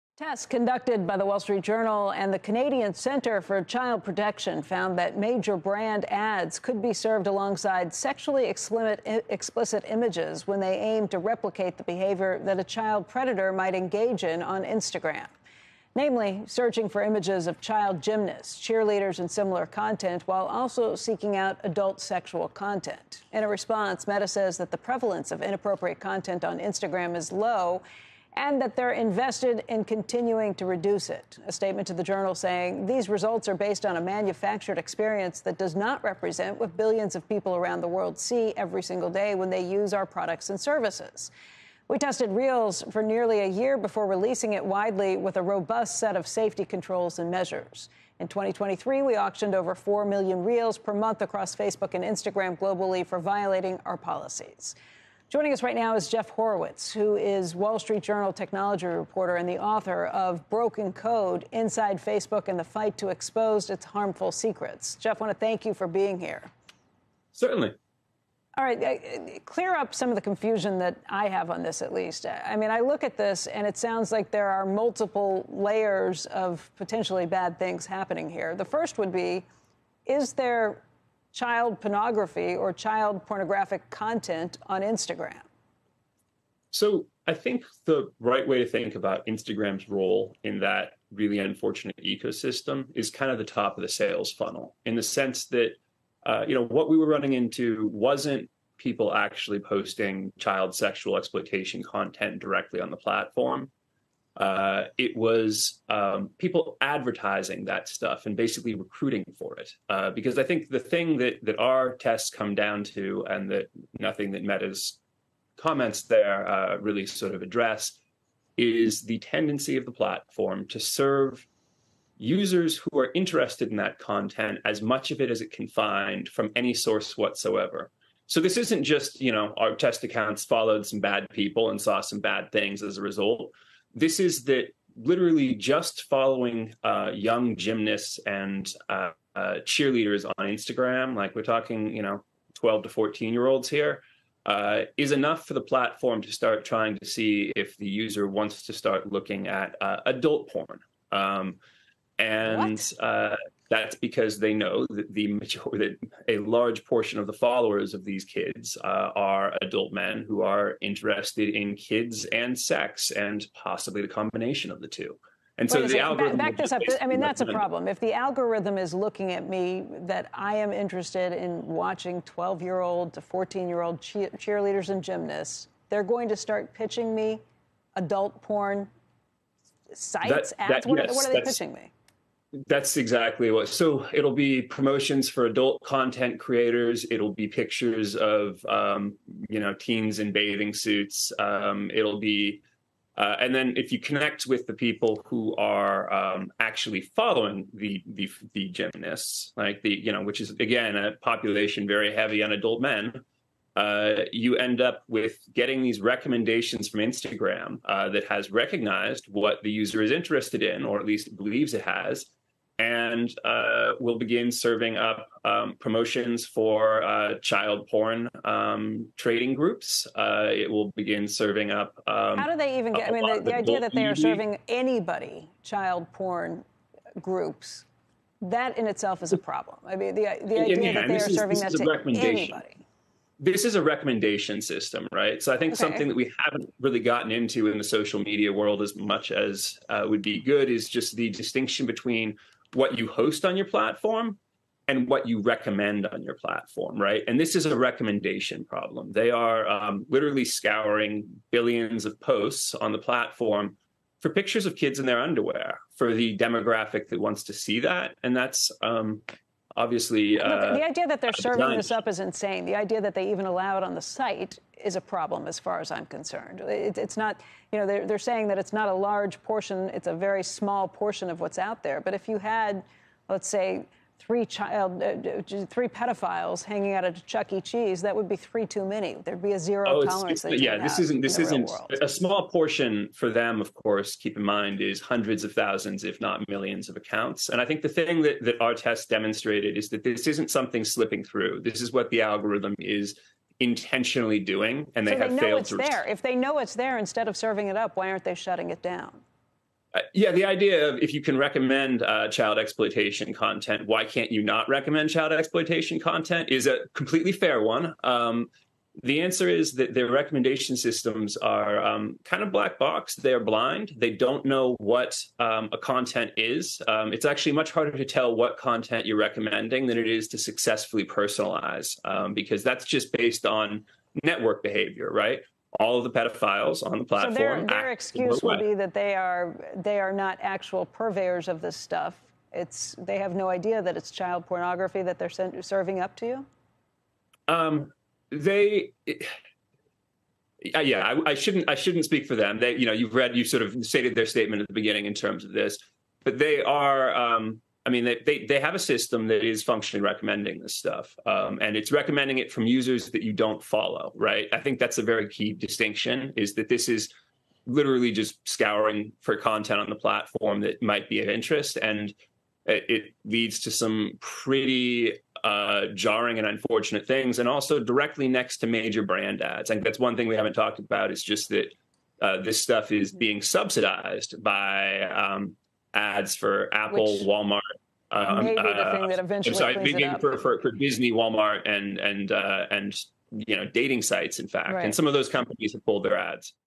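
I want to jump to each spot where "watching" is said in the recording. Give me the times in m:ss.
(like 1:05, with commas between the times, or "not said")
2:51.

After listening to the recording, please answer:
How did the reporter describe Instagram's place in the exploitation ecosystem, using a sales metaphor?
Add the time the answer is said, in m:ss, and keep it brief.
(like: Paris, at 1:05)
top of the sales funnel, at 1:33.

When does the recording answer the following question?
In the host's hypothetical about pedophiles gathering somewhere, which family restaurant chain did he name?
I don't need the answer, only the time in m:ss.
4:37.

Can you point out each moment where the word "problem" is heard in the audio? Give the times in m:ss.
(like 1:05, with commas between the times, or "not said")
2:47, 3:49, 4:08, 4:25.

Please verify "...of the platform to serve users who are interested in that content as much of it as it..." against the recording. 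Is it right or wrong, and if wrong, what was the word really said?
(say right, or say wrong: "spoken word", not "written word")
right.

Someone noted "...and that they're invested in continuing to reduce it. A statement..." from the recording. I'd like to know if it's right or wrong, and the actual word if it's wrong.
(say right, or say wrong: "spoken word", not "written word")
right.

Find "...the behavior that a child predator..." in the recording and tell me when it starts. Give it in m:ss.
0:11.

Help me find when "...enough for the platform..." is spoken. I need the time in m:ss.
2:25.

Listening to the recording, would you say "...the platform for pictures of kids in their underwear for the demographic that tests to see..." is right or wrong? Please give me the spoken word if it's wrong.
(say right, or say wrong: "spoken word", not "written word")
wrong: "wants", not "tests".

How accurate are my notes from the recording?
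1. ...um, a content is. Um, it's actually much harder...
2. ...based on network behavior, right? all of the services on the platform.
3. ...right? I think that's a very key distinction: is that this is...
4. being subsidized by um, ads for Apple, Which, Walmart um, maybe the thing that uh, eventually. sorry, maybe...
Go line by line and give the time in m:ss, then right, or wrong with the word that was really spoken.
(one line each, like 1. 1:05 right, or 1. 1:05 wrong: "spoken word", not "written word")
1. 5:15 right
2. 5:23 wrong: "pedophiles", not "services"
3. 5:54 right
4. 6:13 right.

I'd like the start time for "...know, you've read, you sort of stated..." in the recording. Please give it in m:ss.
5:42.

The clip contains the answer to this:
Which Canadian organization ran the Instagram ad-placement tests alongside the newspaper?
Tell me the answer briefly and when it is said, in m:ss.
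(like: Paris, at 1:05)
Canadian Center for Child Protection, at 0:02.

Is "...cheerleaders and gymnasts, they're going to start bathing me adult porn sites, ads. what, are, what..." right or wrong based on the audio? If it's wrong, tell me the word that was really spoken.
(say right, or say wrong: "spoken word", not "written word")
wrong: "pitching", not "bathing".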